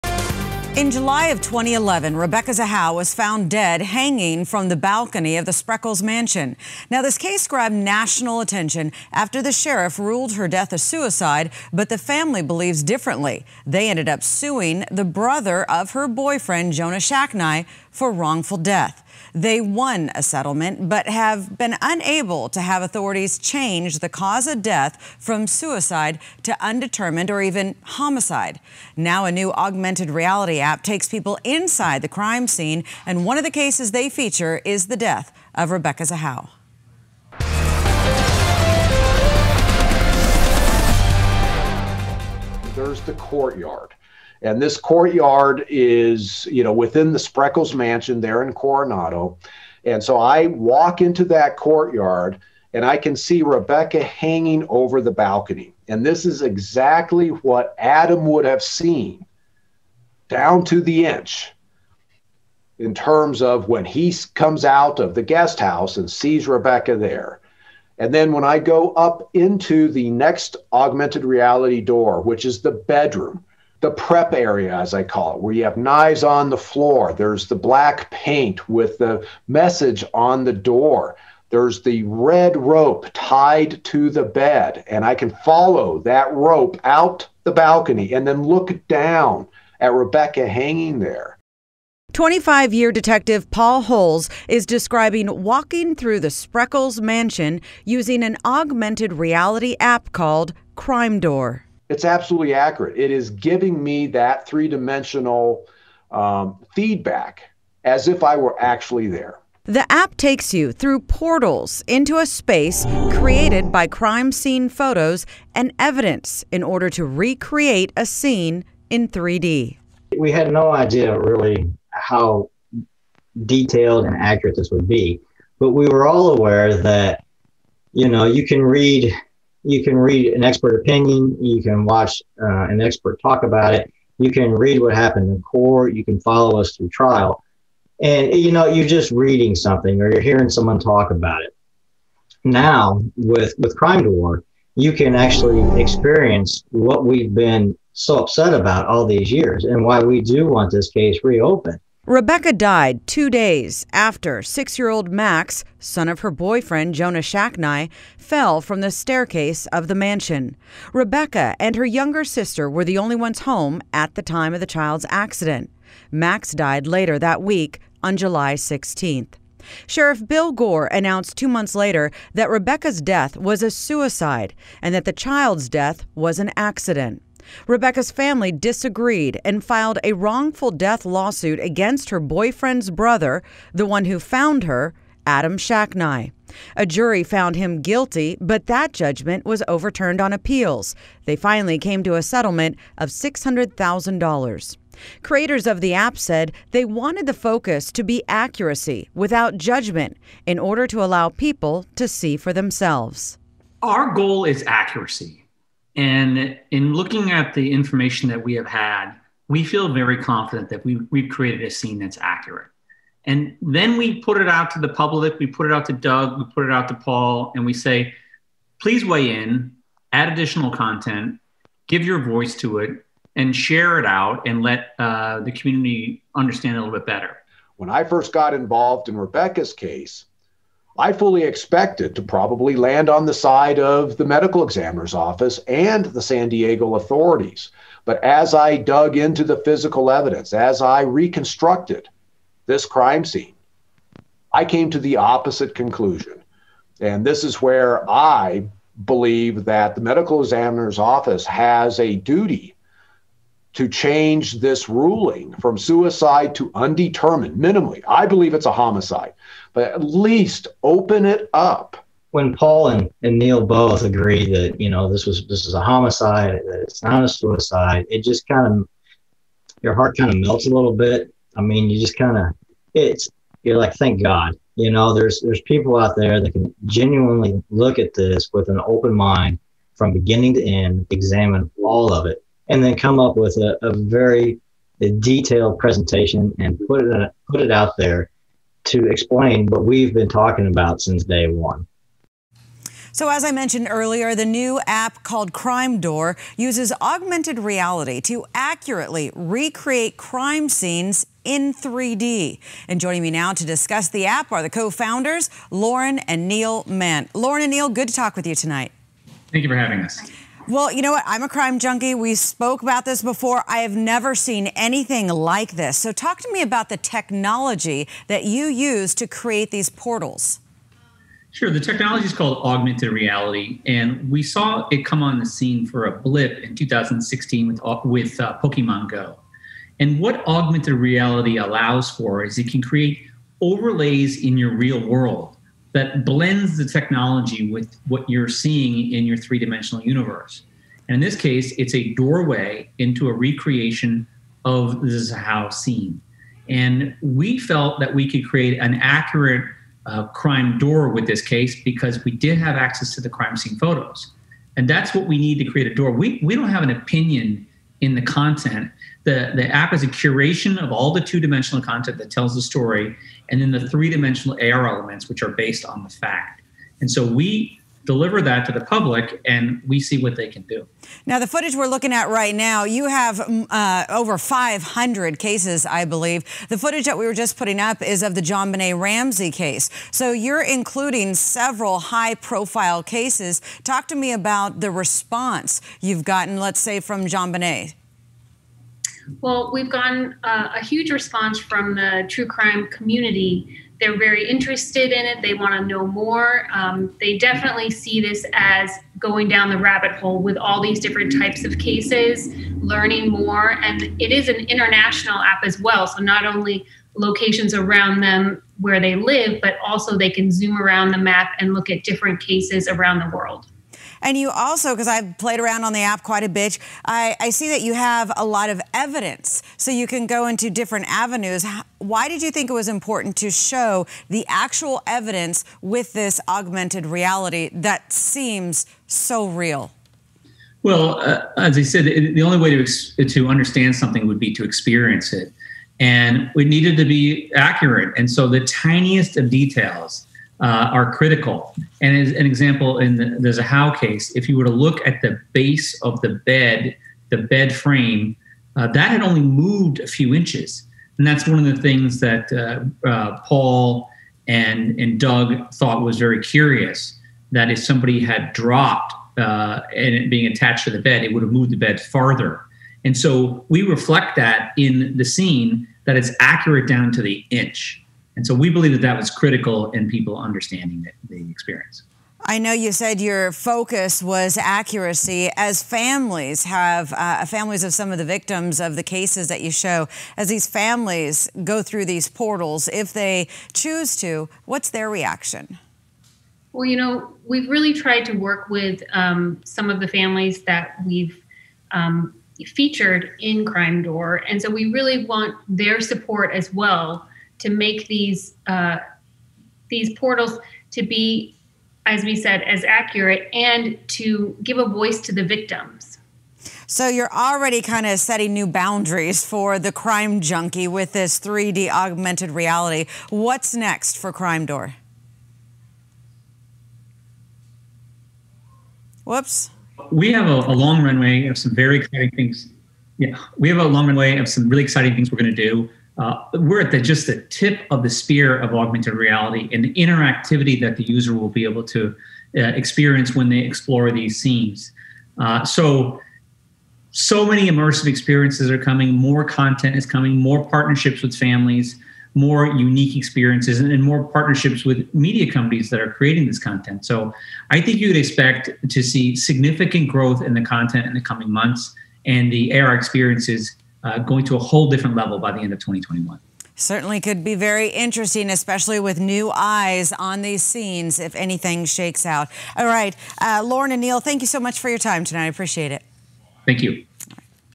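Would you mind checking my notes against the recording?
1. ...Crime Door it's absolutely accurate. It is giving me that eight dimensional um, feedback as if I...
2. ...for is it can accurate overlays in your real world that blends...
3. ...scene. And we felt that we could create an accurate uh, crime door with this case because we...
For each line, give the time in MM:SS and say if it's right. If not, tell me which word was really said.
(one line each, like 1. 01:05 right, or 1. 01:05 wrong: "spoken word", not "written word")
1. 01:40 wrong: "three", not "eight"
2. 05:32 wrong: "create", not "accurate"
3. 05:45 right.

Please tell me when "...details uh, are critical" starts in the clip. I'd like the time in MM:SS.
07:19.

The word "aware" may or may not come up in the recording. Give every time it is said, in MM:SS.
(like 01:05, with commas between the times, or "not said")
02:06.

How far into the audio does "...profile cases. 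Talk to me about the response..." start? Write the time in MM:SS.
06:22.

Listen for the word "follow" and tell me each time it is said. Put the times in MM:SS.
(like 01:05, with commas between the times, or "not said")
01:25, 02:16.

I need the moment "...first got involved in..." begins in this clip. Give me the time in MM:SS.
03:48.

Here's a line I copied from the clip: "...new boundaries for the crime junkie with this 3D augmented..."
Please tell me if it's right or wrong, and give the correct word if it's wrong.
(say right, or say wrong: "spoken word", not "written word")
right.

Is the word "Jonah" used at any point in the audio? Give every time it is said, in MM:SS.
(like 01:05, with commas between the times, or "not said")
00:16, 02:36.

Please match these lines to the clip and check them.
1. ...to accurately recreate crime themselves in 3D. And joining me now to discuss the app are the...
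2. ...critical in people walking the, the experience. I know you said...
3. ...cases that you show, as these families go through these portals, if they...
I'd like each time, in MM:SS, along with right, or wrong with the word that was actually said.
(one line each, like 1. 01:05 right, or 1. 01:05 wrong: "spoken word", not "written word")
1. 04:58 wrong: "scenes", not "themselves"
2. 07:49 wrong: "understanding", not "walking"
3. 07:59 right.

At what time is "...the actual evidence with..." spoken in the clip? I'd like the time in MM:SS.
07:04.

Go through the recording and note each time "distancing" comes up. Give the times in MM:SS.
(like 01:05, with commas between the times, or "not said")
not said.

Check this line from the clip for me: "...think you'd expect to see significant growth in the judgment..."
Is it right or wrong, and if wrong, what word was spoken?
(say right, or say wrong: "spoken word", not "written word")
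wrong: "content", not "judgment".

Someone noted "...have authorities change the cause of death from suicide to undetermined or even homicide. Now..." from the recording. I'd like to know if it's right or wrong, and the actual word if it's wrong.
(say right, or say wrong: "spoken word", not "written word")
right.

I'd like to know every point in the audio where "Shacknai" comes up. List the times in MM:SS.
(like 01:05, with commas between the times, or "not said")
00:16, 02:37, 03:05.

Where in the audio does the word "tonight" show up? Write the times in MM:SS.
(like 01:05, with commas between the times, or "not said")
05:08, 09:25.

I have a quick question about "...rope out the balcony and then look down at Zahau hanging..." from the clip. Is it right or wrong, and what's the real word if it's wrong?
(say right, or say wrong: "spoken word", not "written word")
wrong: "Rebecca", not "Zahau".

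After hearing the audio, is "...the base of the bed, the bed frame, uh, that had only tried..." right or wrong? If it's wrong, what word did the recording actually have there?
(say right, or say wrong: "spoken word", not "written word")
wrong: "moved", not "tried".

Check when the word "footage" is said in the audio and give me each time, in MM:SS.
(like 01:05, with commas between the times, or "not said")
06:11, 06:16.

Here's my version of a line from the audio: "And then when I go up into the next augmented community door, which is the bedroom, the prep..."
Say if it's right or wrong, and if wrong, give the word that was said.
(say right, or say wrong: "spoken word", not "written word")
wrong: "reality", not "community".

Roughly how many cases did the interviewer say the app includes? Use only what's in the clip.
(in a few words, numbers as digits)
over 500.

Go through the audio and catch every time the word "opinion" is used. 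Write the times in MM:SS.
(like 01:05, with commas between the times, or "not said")
02:10, 05:56.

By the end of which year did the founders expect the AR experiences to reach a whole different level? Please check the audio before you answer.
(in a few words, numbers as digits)
2021.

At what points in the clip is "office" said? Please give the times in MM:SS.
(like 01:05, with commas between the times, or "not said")
03:55, 04:10.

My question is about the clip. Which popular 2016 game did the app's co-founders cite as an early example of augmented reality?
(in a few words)
Pokemon Go.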